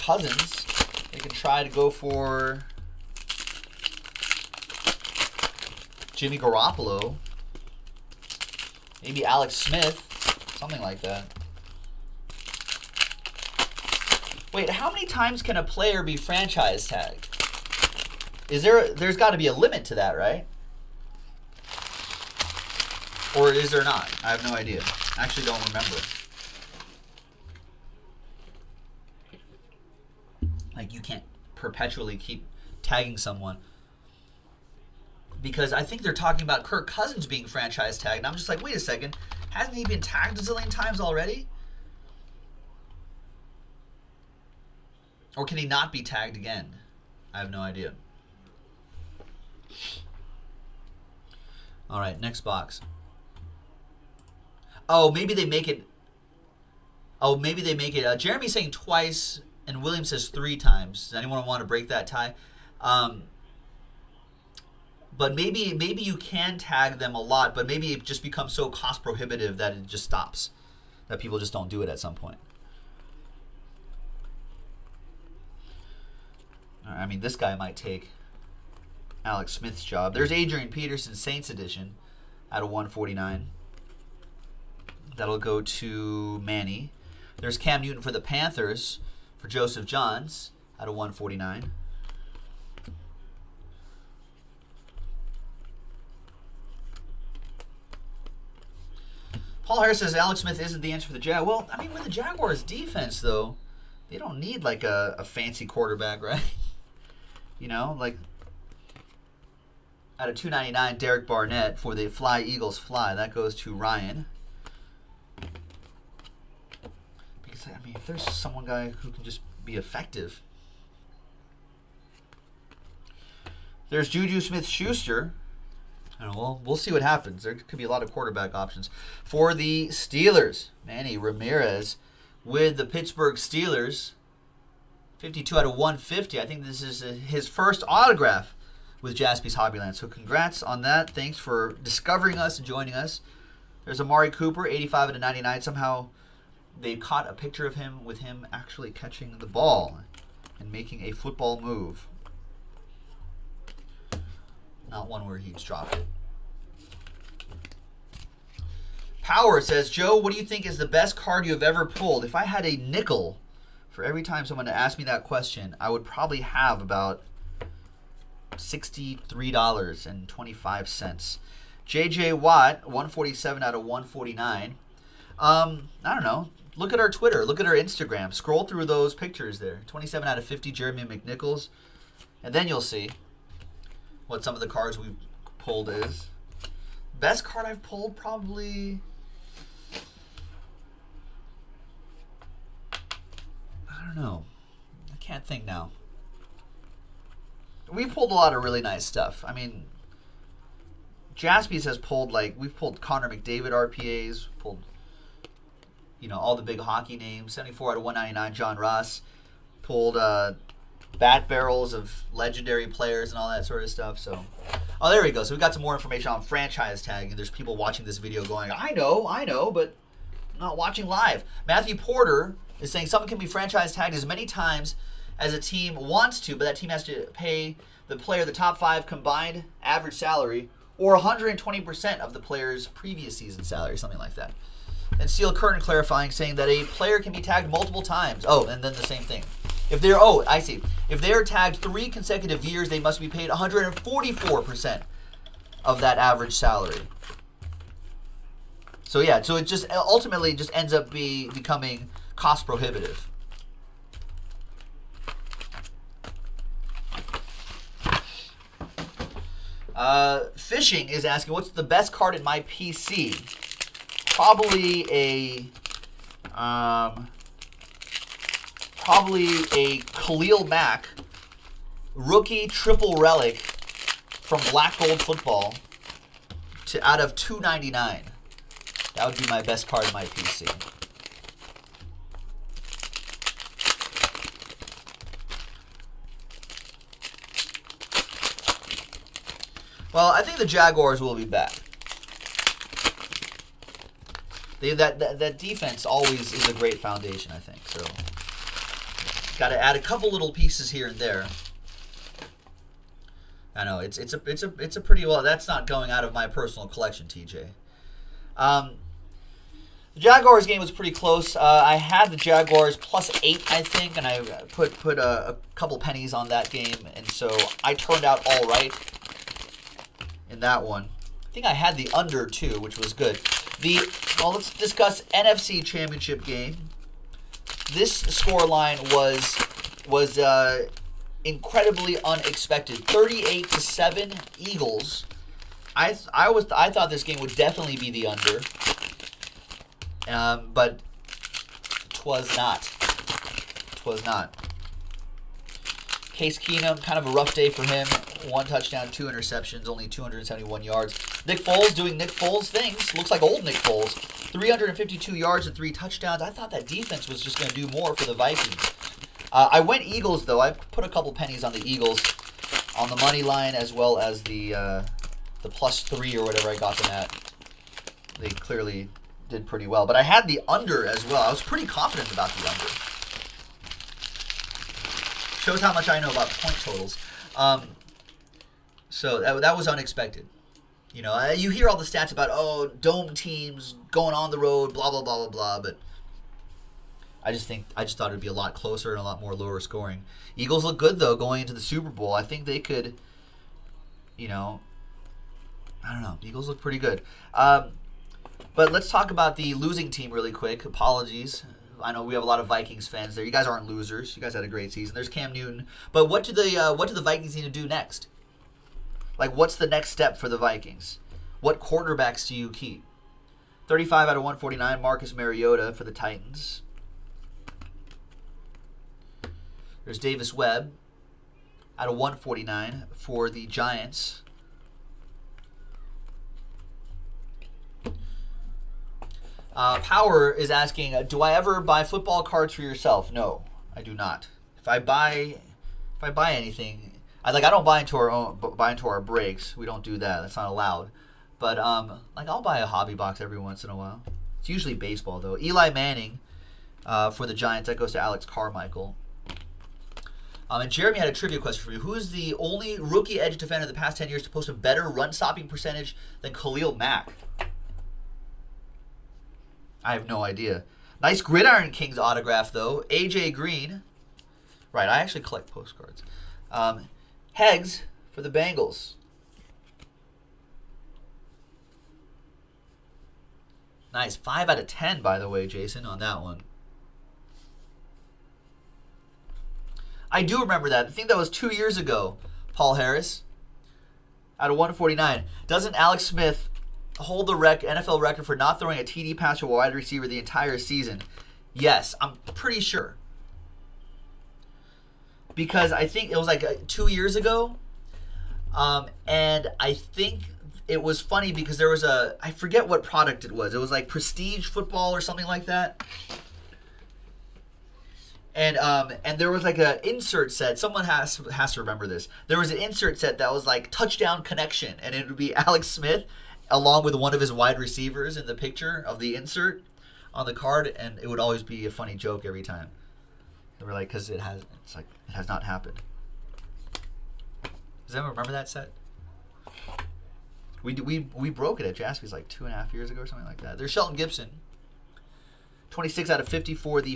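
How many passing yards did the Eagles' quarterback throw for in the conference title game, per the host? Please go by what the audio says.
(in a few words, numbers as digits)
352.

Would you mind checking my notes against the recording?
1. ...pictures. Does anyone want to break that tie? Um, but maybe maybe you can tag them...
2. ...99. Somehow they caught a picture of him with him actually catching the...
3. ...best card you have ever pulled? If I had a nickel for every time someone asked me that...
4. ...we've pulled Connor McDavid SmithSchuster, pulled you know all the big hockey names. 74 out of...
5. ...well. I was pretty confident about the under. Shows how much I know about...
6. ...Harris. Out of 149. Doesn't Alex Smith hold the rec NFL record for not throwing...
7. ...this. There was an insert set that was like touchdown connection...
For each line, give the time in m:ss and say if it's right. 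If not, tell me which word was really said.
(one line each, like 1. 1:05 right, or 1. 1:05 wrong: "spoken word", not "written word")
1. 1:00 wrong: "times", not "pictures"
2. 2:25 right
3. 2:40 right
4. 3:22 wrong: "RPAs", not "SmithSchuster"
5. 6:11 right
6. 8:02 right
7. 8:32 right.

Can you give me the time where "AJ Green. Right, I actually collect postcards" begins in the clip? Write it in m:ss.
7:43.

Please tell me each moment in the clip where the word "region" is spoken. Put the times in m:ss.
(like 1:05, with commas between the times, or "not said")
not said.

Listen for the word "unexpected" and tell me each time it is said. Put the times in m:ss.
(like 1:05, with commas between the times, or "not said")
5:32, 6:19.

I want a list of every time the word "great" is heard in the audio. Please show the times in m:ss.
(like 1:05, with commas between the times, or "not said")
4:56, 6:44.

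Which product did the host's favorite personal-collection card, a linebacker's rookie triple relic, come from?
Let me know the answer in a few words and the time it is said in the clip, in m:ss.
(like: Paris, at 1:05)
Black Gold Football, at 4:34.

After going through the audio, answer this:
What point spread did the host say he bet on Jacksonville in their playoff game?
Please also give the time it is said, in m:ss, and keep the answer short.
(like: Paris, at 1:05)
plus 8, at 5:12.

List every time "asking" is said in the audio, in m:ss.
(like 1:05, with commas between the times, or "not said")
4:21, 7:10.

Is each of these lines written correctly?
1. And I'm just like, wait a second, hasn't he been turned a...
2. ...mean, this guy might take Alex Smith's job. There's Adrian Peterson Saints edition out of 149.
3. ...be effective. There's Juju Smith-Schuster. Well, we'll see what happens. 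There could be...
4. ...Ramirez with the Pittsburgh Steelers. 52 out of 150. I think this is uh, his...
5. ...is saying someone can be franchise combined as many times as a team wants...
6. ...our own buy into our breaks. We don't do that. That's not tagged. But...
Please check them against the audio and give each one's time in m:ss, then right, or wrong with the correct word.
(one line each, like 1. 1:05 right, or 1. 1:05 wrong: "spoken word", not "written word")
1. 0:38 wrong: "tagged", not "turned"
2. 1:17 right
3. 1:59 right
4. 2:11 right
5. 3:42 wrong: "tagged", not "combined"
6. 7:18 wrong: "allowed", not "tagged".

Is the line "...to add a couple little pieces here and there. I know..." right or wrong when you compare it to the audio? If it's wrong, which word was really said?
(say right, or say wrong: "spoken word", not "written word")
right.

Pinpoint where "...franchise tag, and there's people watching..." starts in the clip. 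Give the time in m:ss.
3:36.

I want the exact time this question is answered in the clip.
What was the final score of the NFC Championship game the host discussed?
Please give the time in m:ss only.
5:33.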